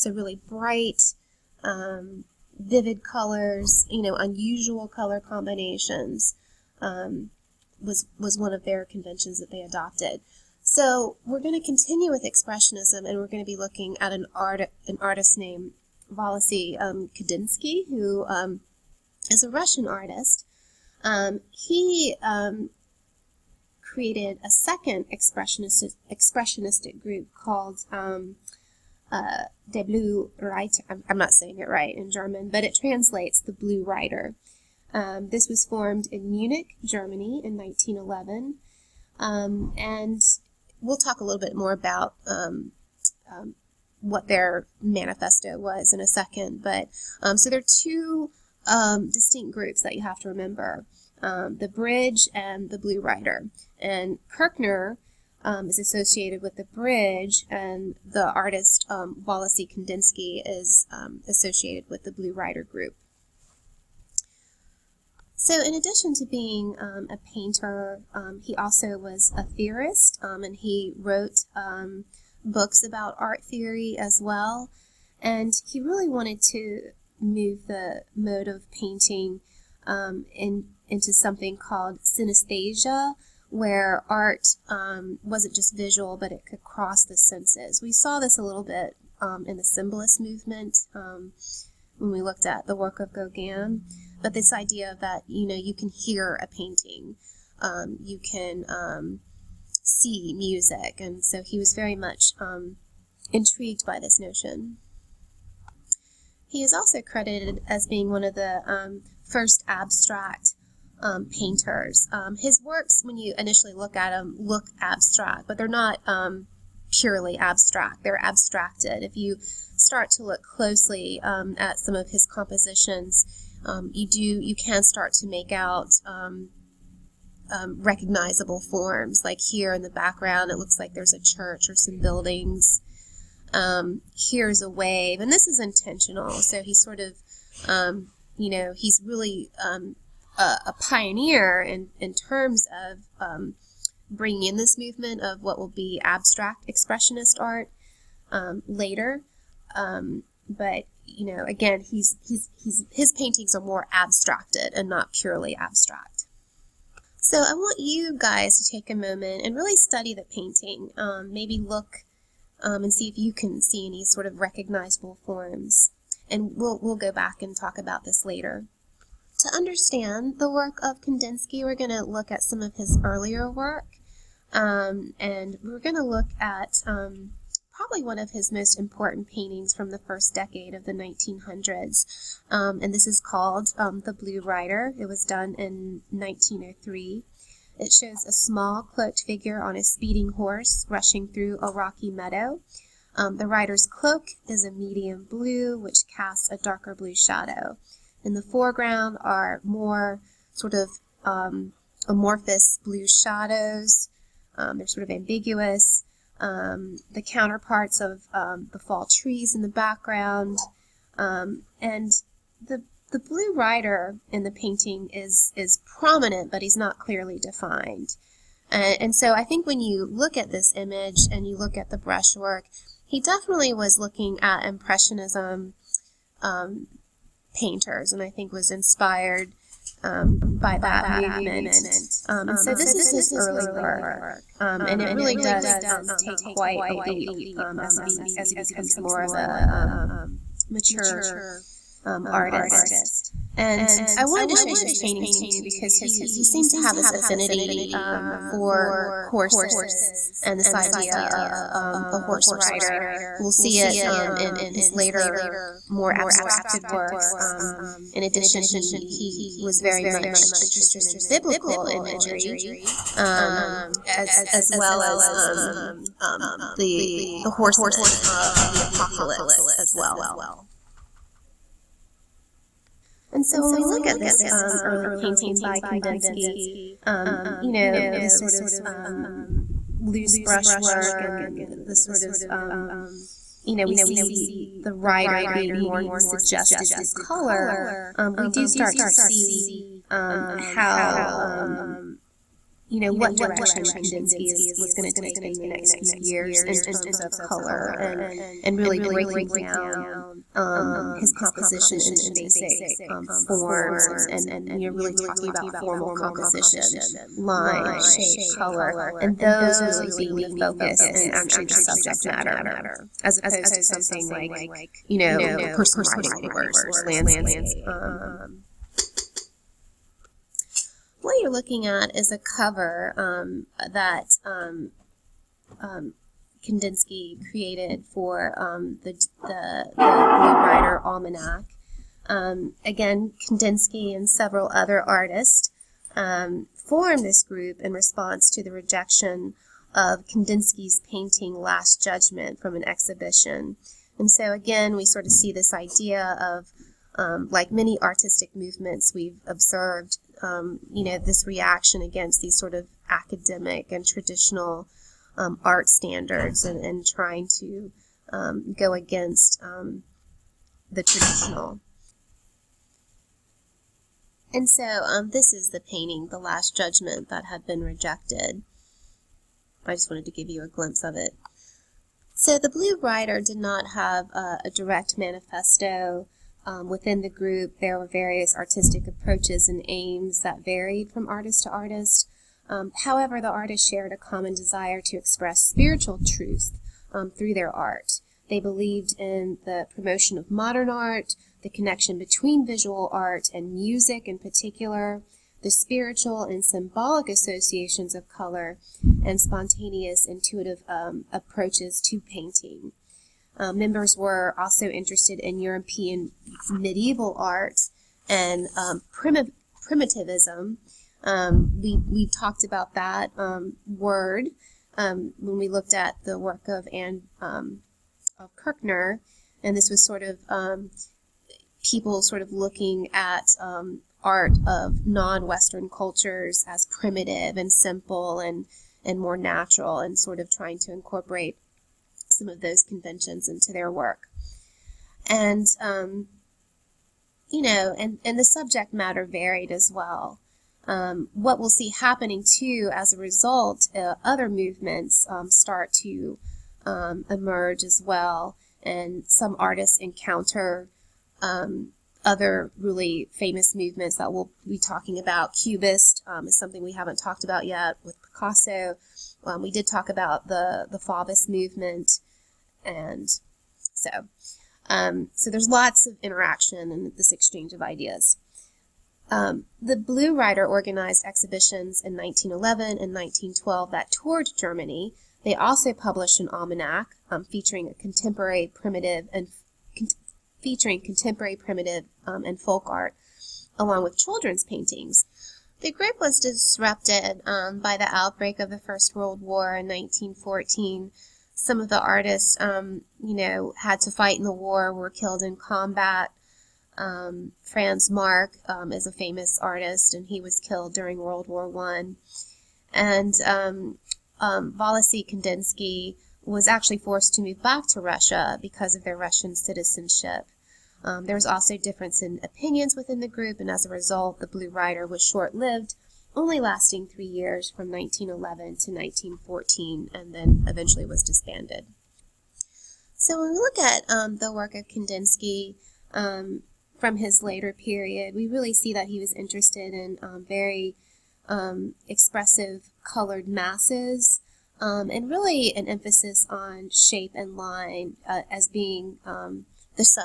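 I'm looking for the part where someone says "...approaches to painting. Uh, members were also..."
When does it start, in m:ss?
6:41.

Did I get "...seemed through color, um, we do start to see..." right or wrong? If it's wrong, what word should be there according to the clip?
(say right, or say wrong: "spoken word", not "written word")
wrong: "suggested", not "seemed".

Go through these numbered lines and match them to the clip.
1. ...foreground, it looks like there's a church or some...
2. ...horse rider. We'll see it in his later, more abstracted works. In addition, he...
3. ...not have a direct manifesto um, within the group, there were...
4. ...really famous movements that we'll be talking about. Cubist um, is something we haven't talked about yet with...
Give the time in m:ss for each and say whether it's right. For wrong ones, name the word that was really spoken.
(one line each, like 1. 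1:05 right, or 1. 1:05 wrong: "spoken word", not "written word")
1. 2:09 wrong: "background", not "foreground"
2. 4:12 right
3. 6:13 right
4. 7:32 right.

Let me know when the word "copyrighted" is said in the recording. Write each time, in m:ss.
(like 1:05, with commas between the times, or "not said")
not said.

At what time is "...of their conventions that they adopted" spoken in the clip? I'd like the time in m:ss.
0:08.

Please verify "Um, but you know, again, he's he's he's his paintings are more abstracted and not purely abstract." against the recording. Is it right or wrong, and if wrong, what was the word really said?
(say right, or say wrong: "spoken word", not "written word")
right.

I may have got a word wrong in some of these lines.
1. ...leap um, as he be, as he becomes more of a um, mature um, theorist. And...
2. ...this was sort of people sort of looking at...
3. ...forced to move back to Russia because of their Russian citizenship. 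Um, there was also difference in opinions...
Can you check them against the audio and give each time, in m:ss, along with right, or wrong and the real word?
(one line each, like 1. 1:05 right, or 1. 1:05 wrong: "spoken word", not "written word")
1. 3:56 wrong: "artist", not "theorist"
2. 6:59 right
3. 8:26 right.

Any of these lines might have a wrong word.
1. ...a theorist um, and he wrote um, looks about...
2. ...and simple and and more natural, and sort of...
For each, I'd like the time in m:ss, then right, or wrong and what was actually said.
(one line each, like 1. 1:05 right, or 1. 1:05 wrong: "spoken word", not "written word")
1. 1:09 wrong: "books", not "looks"
2. 7:07 right.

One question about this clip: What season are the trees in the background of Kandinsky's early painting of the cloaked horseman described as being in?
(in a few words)
fall.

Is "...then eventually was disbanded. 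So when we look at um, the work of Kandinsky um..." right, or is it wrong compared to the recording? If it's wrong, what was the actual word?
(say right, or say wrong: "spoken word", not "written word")
right.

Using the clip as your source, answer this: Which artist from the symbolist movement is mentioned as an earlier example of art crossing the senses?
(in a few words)
Gauguin.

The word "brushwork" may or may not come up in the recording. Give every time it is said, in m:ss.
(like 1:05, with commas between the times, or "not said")
3:41, 4:40.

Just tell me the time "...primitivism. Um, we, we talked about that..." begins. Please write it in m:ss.
6:49.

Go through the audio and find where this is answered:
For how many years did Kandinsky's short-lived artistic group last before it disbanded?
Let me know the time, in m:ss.
8:37.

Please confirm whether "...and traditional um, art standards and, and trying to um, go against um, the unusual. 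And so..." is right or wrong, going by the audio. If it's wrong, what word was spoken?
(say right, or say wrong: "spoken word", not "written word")
wrong: "traditional", not "unusual".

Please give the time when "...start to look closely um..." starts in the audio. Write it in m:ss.
1:59.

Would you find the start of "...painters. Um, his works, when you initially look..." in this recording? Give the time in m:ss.
1:51.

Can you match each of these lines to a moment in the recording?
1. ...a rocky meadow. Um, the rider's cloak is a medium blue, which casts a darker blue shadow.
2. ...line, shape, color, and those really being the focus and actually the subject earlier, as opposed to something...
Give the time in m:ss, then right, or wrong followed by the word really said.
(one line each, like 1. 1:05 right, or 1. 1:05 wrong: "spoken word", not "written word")
1. 3:11 right
2. 5:07 wrong: "matter", not "earlier".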